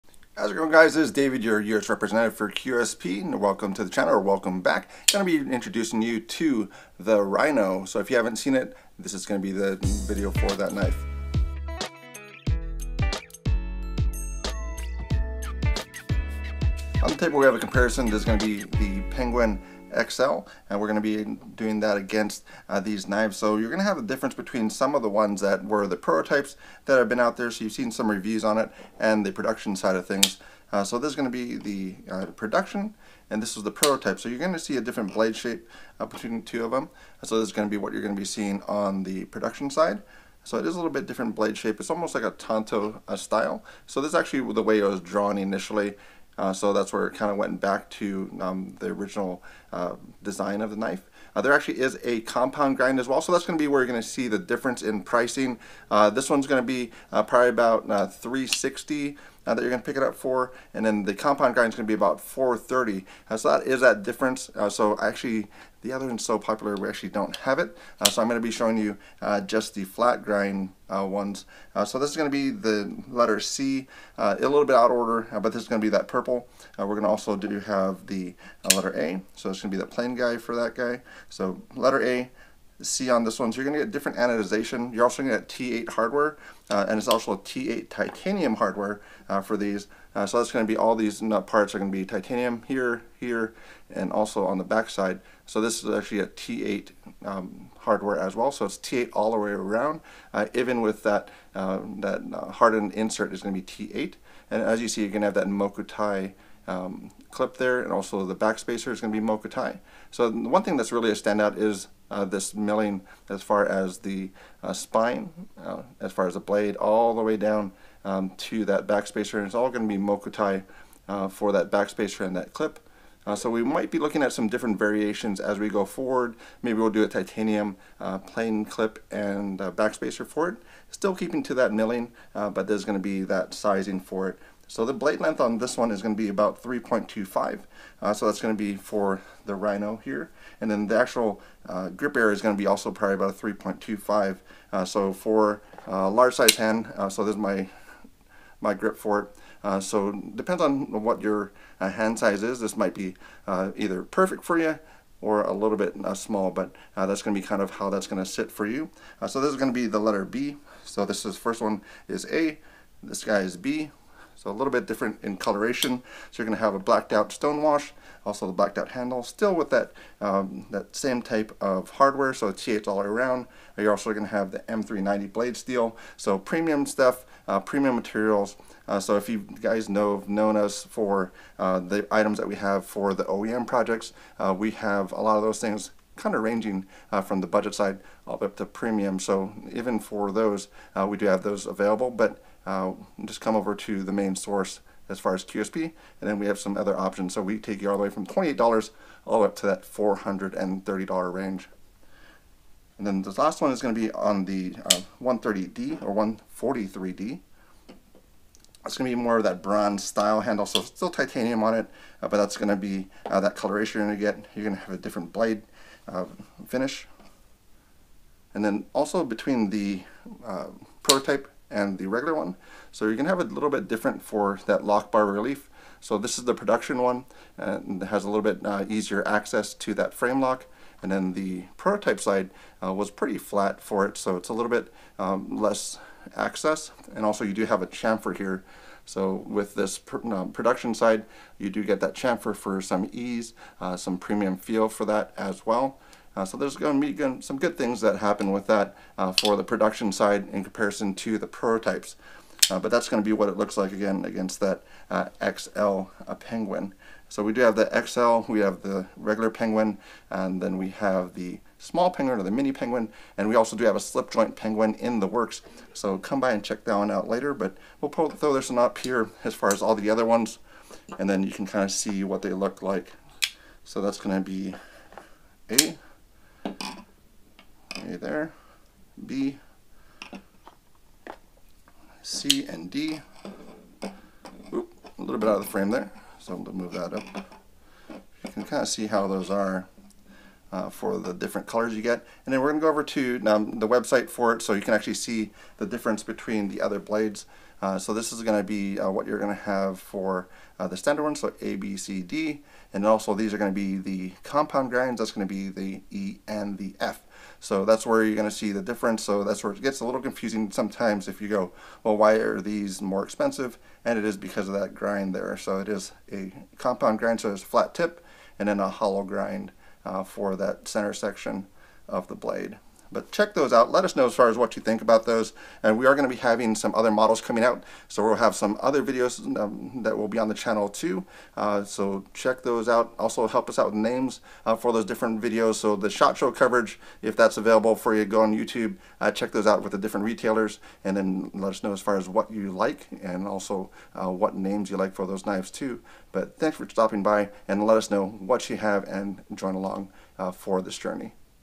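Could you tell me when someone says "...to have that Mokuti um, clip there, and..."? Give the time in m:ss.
1:45.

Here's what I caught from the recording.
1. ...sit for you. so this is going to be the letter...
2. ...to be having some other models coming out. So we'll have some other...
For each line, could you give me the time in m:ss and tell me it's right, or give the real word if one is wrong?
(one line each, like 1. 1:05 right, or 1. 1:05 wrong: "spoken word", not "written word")
1. 2:38 right
2. 5:26 right.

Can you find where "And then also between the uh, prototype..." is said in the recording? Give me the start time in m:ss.
3:38.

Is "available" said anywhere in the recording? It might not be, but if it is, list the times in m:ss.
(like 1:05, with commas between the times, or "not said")
3:11, 5:37.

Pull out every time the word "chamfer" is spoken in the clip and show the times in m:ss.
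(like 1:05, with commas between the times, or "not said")
3:57, 4:02.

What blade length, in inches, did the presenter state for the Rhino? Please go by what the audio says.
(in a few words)
3.25.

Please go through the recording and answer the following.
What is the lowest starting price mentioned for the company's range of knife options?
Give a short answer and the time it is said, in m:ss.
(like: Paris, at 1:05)
$28, at 3:18.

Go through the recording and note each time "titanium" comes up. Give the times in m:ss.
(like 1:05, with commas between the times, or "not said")
1:27, 1:32, 2:07, 3:31.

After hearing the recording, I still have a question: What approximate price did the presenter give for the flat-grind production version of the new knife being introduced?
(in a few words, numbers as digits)
$360.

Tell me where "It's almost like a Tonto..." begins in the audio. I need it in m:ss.
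0:41.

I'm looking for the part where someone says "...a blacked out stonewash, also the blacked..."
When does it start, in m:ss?
2:46.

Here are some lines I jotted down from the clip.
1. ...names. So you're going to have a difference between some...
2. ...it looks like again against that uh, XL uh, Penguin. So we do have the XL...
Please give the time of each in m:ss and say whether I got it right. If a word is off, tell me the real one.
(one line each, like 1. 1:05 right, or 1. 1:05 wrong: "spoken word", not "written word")
1. 0:23 wrong: "knives", not "names"
2. 4:13 right.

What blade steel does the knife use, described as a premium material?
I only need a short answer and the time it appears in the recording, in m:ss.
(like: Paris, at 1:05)
M390, at 2:54.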